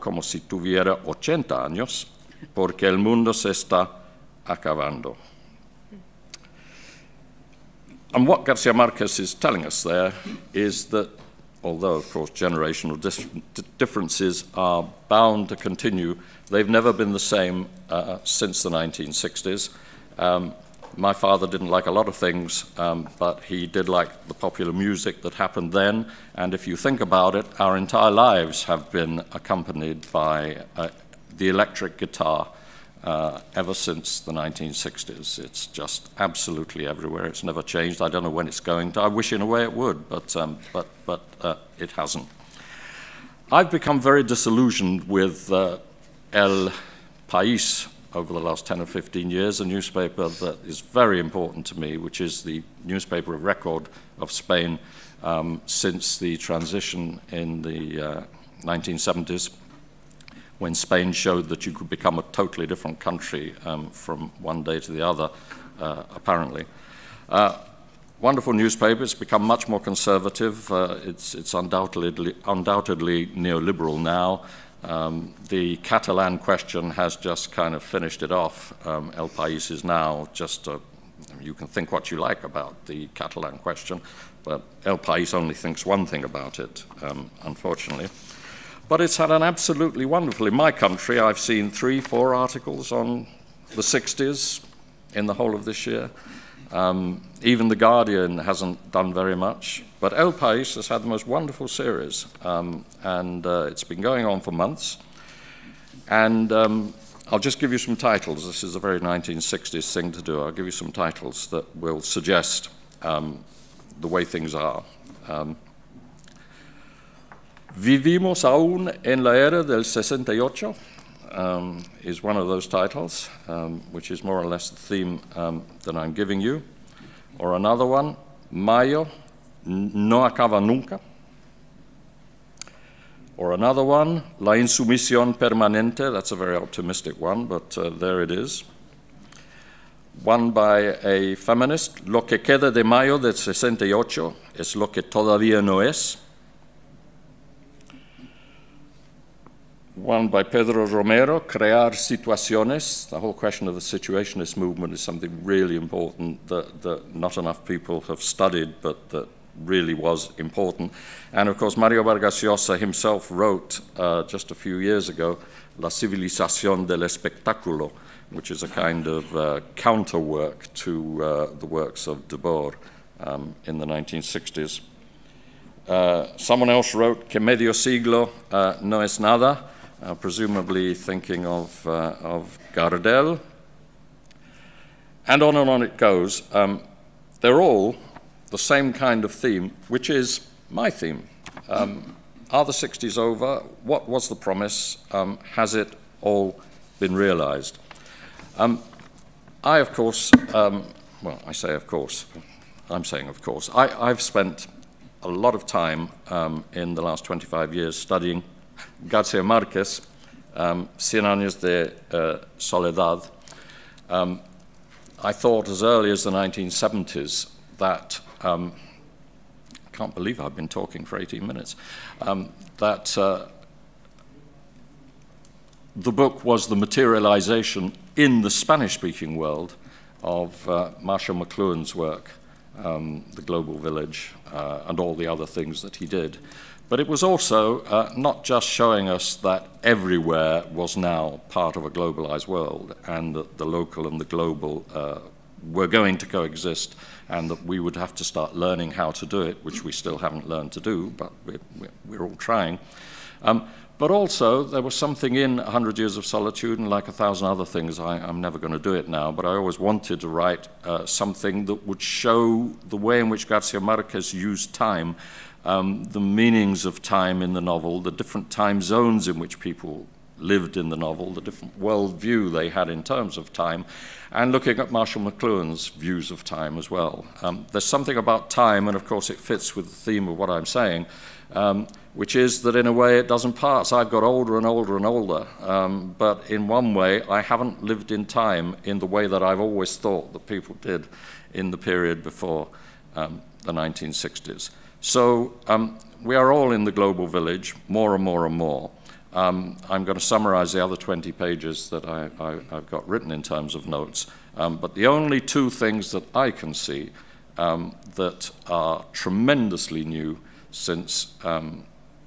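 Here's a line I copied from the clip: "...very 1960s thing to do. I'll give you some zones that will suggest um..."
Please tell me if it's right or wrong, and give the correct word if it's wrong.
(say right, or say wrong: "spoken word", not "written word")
wrong: "titles", not "zones".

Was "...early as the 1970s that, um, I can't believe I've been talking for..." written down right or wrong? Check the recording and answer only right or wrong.
right.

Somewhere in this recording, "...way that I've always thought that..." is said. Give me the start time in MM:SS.
04:49.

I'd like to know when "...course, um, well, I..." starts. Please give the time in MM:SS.
03:19.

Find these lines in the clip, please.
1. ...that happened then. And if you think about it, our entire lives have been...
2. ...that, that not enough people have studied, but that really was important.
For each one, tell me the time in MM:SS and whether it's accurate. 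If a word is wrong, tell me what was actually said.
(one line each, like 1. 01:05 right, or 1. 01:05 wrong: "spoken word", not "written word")
1. 00:25 right
2. 02:36 right.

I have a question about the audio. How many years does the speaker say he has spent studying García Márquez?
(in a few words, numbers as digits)
25.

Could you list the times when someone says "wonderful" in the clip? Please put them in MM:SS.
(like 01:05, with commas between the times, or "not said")
01:08, 01:30, 01:41.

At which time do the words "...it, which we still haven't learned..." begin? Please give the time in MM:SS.
04:09.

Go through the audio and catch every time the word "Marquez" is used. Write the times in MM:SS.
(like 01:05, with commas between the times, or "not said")
00:08, 04:23.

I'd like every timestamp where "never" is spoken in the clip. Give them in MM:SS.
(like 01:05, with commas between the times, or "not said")
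00:16, 00:37, 04:18.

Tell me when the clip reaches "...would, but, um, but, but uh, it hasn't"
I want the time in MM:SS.
00:39.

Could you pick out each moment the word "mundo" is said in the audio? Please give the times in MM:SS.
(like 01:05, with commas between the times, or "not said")
00:02.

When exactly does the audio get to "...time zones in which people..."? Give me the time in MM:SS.
04:28.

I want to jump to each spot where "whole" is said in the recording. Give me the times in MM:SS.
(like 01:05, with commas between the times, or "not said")
01:35, 02:33.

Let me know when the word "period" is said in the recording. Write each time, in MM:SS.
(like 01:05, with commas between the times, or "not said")
04:51.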